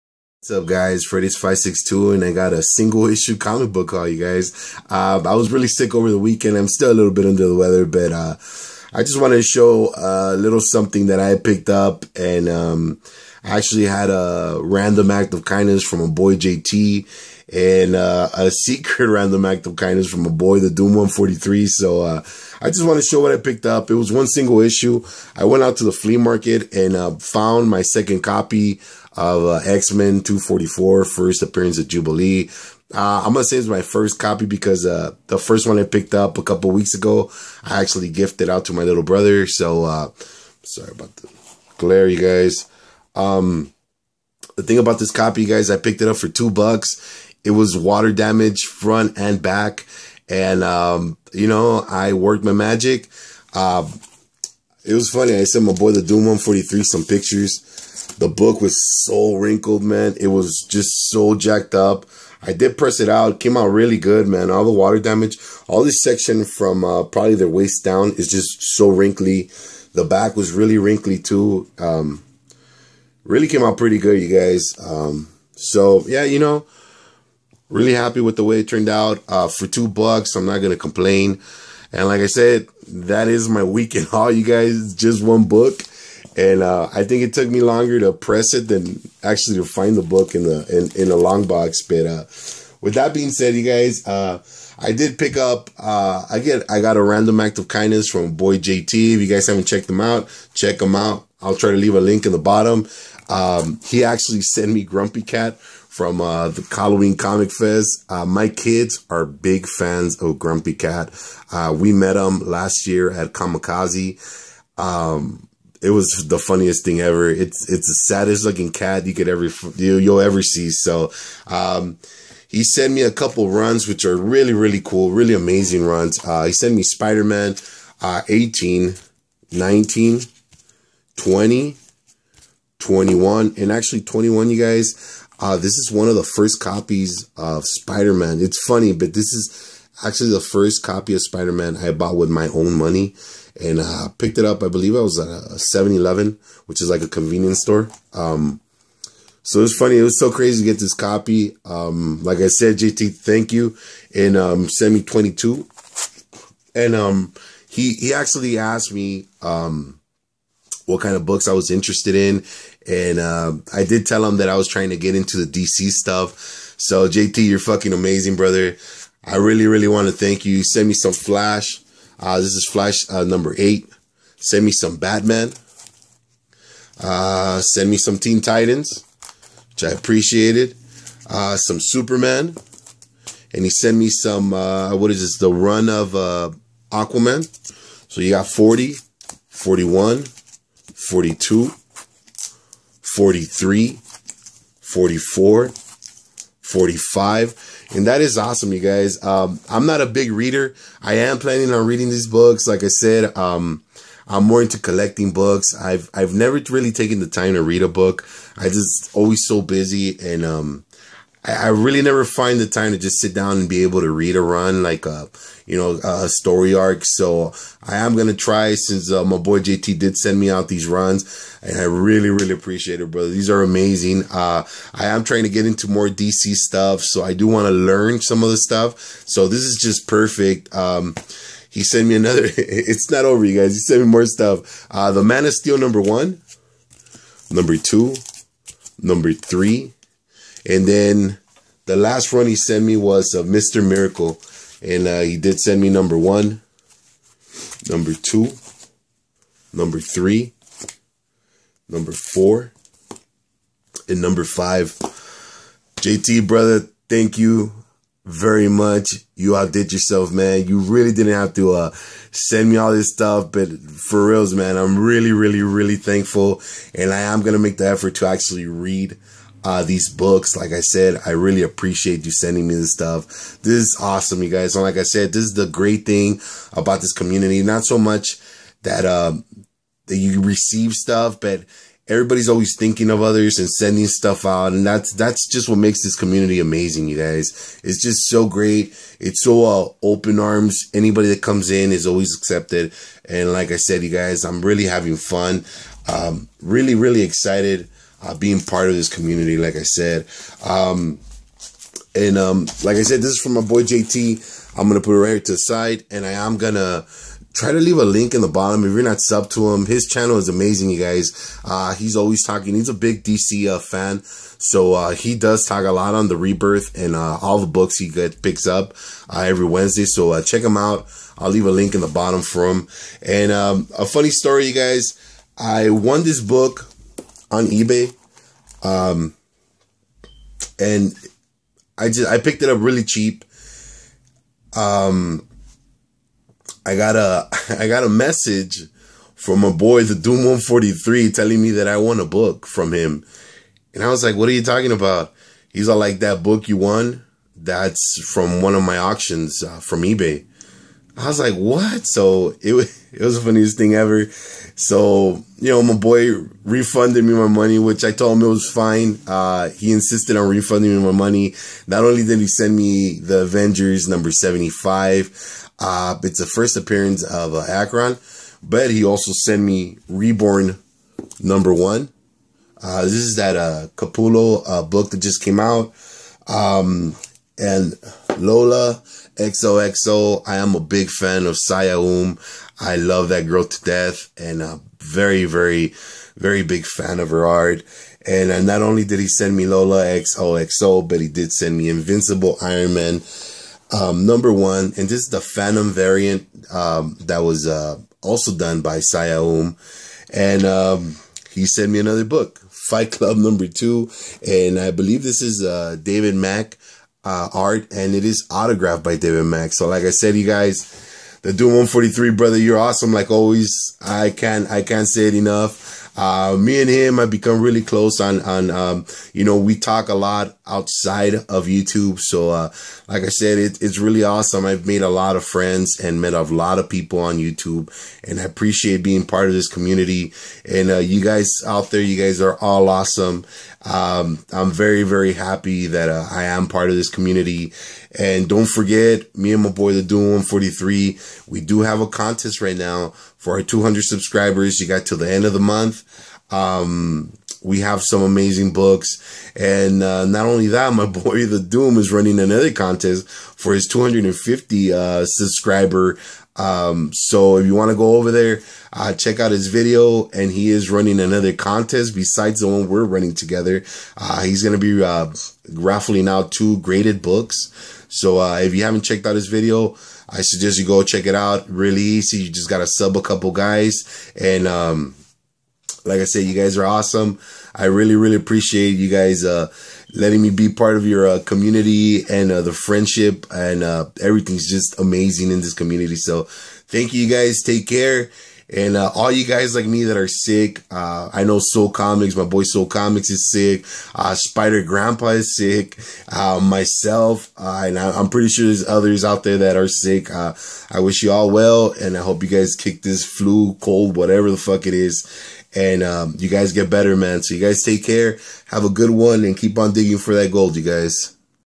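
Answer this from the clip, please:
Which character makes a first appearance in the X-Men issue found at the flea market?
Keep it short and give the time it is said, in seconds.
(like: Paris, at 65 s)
Jubilee, at 31 s.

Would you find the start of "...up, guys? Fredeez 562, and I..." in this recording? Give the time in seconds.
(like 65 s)
0 s.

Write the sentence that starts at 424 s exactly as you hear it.
I've made a lot of friends and met a lot of people on YouTube and I appreciate being part of this community.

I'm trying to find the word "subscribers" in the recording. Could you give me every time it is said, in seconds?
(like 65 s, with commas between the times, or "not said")
444 s, 455 s.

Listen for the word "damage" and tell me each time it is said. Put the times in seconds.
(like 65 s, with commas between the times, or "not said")
48 s, 64 s.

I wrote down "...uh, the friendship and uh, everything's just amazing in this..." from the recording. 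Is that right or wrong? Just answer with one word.
right.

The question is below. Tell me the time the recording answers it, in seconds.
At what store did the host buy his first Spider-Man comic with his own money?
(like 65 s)
145 s.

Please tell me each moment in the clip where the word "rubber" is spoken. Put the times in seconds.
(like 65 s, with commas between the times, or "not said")
not said.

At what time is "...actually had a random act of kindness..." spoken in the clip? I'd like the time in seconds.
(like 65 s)
13 s.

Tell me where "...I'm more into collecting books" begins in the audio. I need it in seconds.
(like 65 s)
204 s.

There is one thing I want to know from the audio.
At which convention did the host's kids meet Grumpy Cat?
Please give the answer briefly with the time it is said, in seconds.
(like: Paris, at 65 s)
Comikaze, at 113 s.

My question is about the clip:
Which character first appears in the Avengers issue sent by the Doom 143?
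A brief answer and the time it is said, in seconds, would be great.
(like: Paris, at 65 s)
Arkon, at 367 s.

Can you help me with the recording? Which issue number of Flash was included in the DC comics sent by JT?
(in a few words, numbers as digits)
8.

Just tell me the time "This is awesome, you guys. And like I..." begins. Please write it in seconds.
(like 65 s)
273 s.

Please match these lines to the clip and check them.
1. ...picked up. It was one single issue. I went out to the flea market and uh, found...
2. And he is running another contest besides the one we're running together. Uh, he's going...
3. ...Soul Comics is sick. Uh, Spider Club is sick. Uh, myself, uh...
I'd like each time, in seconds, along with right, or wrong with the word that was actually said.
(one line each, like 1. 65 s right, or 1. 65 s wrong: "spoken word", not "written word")
1. 23 s right
2. 460 s right
3. 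492 s wrong: "Grandpa", not "Club".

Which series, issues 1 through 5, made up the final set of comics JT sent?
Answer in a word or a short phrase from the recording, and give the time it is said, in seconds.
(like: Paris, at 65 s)
Mr. Miracle, at 243 s.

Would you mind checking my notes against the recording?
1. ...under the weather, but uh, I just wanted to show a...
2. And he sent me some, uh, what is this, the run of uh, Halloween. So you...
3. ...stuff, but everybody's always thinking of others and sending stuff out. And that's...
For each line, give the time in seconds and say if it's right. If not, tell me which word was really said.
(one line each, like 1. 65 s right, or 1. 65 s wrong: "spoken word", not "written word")
1. 7 s right
2. 183 s wrong: "Aquaman", not "Halloween"
3. 280 s right.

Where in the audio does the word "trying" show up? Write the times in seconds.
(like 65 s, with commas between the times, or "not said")
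164 s, 225 s.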